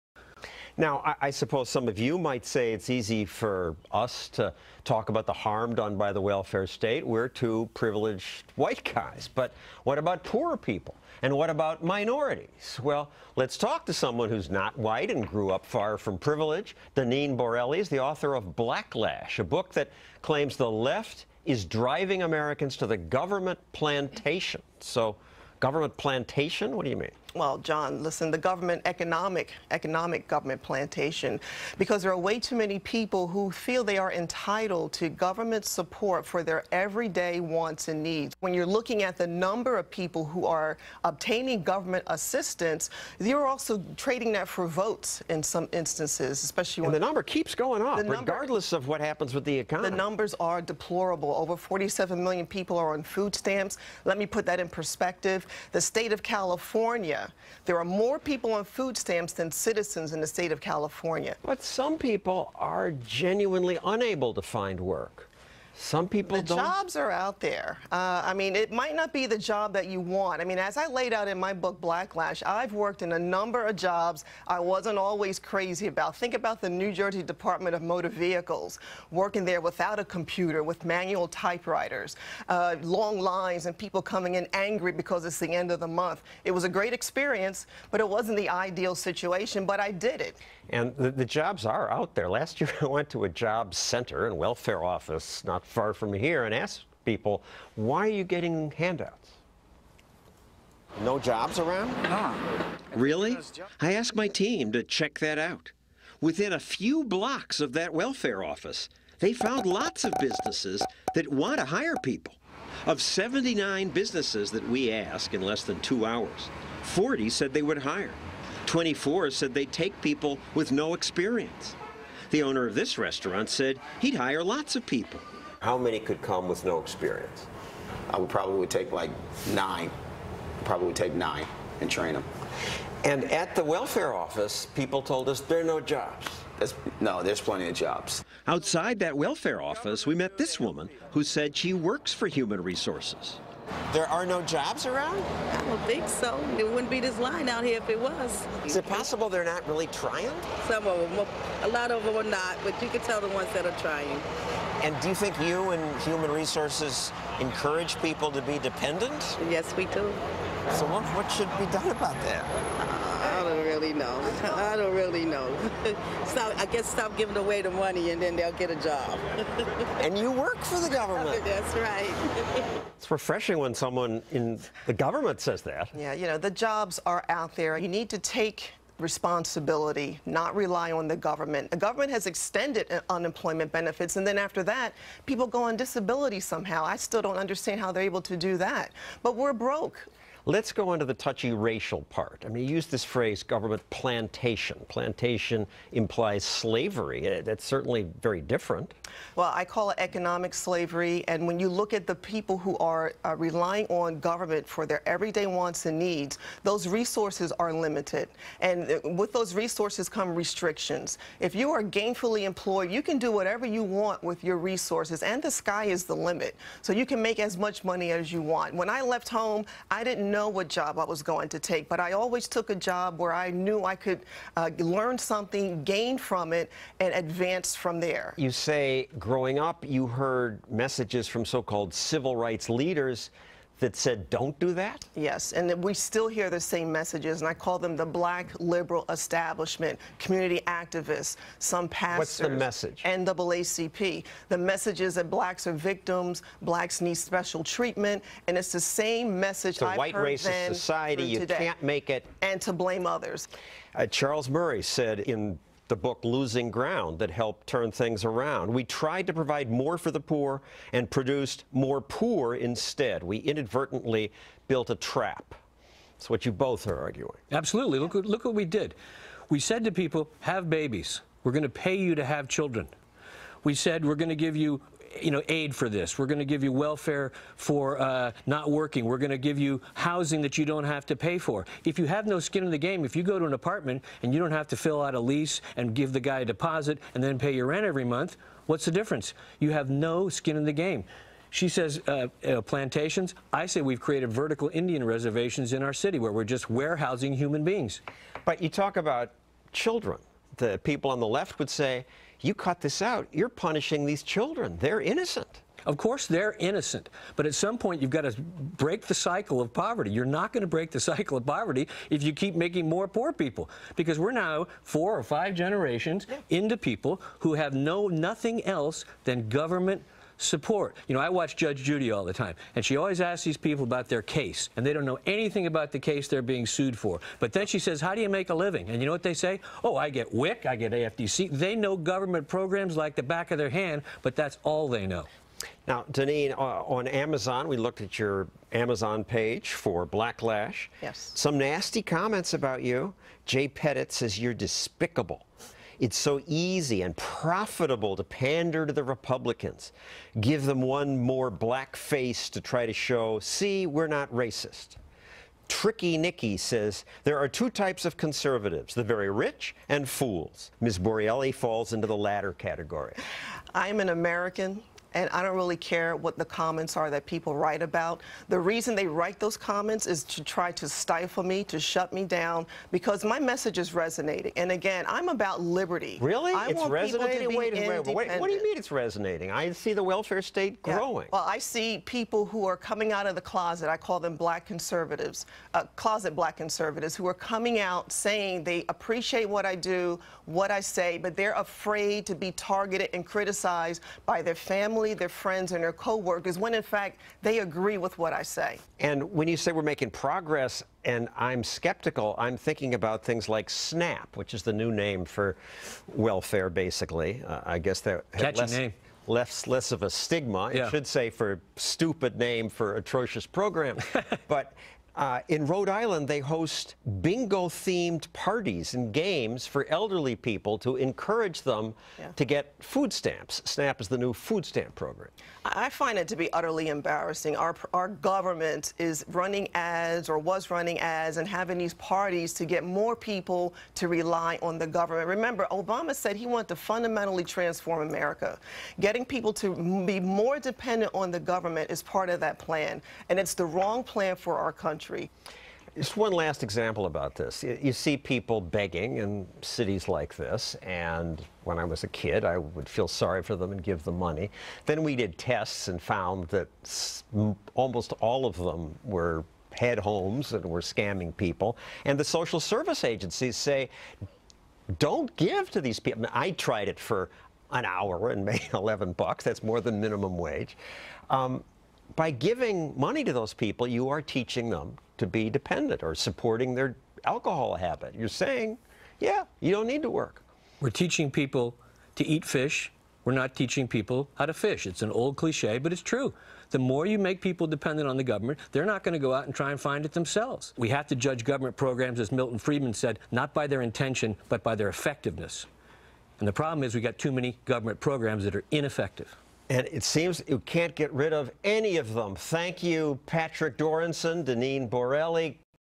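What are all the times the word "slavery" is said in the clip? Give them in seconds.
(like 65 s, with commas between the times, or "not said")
196 s, 200 s.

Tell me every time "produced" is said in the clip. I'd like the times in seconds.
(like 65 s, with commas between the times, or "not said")
261 s.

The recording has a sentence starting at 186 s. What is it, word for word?
I still don't understand how they're able to do that.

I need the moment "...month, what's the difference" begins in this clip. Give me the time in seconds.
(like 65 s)
288 s.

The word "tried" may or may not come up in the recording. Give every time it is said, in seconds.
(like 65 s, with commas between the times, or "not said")
258 s, 466 s.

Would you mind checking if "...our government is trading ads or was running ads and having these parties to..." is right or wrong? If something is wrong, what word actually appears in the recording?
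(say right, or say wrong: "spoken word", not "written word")
wrong: "running", not "trading".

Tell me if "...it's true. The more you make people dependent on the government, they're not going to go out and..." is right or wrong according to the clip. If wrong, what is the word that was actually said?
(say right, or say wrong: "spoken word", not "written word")
right.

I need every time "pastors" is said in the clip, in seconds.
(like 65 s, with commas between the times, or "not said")
241 s.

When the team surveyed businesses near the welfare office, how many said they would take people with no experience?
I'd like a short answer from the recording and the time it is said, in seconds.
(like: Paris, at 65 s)
24, at 118 s.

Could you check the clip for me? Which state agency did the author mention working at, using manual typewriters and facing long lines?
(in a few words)
New Jersey Department of Motor Vehicles.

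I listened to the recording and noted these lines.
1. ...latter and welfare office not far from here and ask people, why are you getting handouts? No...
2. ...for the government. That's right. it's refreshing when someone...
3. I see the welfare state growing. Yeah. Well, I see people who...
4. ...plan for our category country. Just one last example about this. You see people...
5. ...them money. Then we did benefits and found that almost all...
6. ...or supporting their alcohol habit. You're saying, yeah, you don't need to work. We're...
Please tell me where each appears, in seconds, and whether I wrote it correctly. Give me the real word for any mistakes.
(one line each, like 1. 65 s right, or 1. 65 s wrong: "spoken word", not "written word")
1. 93 s wrong: "center", not "latter"
2. 170 s right
3. 379 s right
4. 444 s wrong: "country", not "category"
5. 454 s wrong: "tests", not "benefits"
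6. 476 s right.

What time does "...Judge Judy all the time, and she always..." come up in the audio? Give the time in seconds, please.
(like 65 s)
321 s.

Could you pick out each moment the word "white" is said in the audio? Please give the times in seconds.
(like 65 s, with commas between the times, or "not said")
8 s, 14 s, 249 s.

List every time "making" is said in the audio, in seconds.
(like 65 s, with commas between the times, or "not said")
312 s, 399 s.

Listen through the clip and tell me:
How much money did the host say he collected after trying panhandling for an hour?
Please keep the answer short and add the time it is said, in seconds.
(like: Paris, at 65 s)
$11, at 468 s.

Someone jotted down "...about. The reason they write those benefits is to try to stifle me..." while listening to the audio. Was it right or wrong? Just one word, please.
wrong.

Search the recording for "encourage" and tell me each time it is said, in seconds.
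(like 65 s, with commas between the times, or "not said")
157 s, 420 s.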